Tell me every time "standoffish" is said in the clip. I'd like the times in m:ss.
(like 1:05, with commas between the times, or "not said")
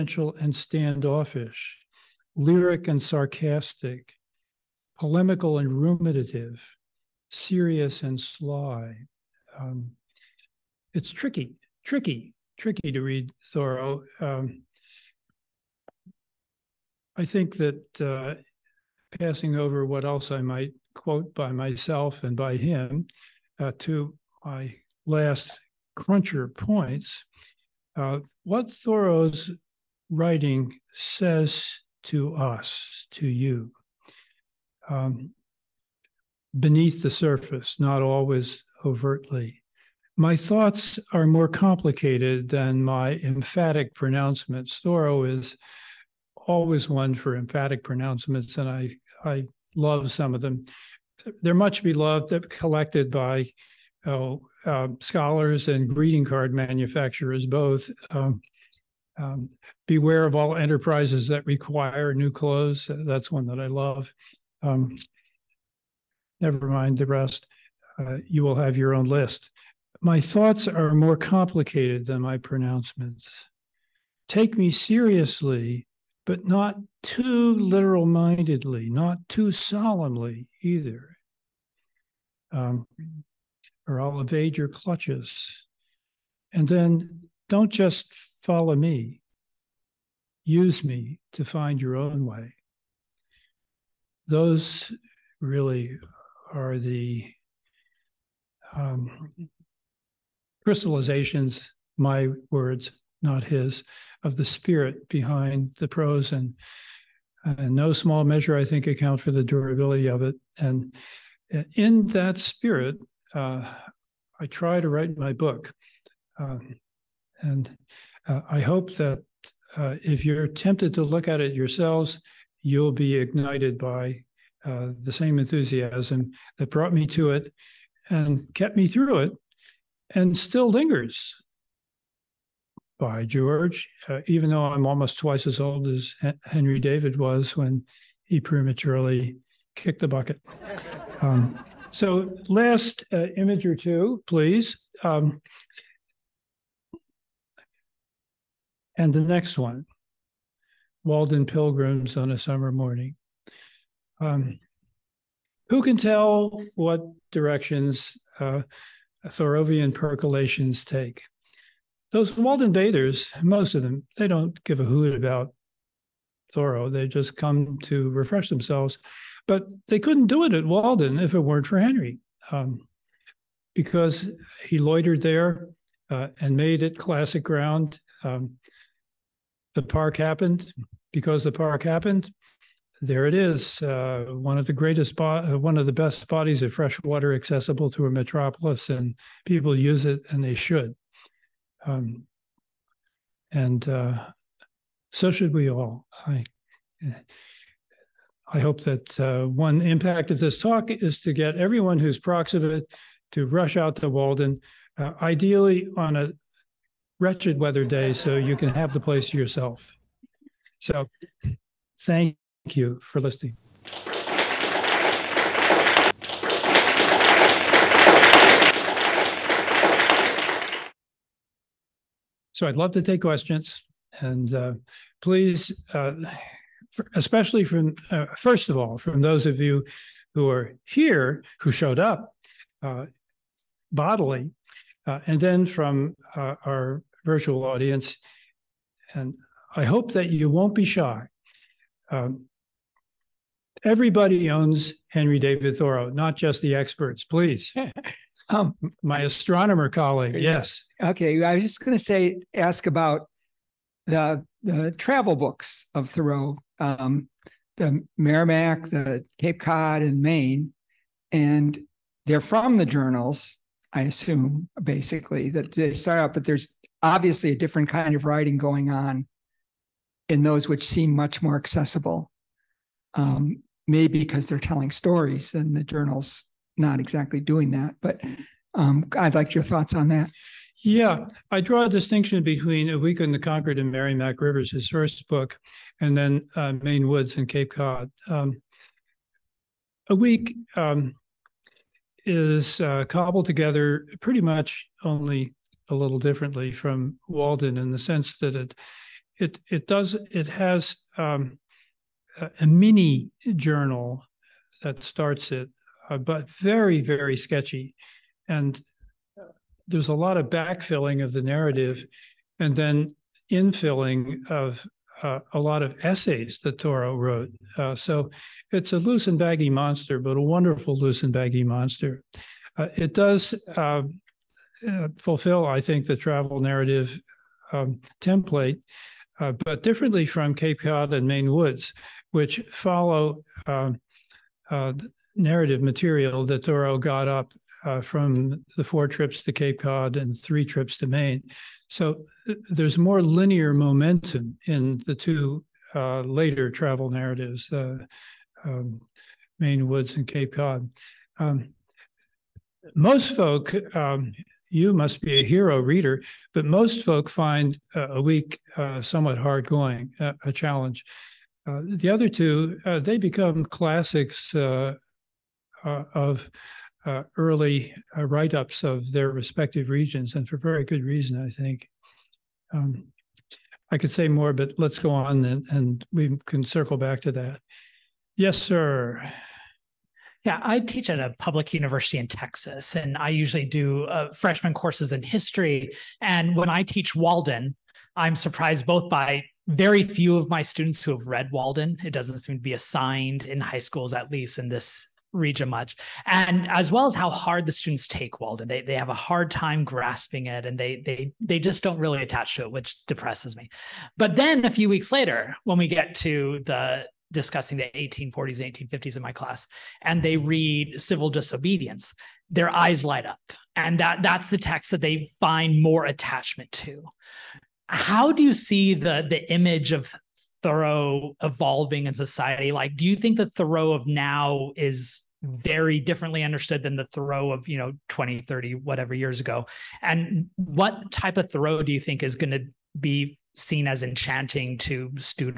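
0:00.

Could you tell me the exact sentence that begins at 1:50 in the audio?
And uh, in that spirit, uh, I try to write my book.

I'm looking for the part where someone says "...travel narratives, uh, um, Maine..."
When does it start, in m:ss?
5:46.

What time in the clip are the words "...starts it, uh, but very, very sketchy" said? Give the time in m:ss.
5:05.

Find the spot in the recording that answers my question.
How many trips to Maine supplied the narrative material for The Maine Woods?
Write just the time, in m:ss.
5:40.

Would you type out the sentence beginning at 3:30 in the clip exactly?
So, thank Thank you for listening.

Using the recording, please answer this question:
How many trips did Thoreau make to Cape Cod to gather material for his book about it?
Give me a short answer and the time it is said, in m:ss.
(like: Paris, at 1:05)
4, at 5:38.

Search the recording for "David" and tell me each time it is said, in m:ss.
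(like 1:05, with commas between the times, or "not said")
2:16, 4:05.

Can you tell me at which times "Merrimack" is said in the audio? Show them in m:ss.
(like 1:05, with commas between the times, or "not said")
4:18, 4:43.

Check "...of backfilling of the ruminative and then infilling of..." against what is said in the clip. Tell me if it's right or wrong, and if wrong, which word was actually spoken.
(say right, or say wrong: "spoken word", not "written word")
wrong: "narrative", not "ruminative".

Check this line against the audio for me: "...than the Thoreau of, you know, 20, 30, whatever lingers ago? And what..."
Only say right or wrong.
wrong.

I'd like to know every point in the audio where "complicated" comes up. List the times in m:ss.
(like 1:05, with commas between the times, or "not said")
0:41, 1:11.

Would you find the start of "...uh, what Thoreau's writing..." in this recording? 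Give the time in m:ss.
0:27.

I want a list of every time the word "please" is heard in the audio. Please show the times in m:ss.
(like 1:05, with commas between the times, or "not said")
2:24, 3:45, 4:07.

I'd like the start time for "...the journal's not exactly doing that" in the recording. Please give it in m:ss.
4:35.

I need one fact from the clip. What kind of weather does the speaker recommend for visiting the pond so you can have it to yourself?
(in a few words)
a wretched weather day.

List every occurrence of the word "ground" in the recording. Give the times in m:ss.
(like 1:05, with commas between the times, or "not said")
2:57.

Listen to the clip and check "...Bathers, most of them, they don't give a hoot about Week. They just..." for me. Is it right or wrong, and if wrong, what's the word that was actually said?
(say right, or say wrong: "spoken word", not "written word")
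wrong: "Thoreau", not "Week".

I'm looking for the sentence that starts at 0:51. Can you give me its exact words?
They're much beloved, collected by oh, uh, scholars and greeting card manufacturers both.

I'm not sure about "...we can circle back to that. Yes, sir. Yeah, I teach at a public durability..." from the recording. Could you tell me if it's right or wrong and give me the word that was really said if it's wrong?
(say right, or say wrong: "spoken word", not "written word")
wrong: "university", not "durability".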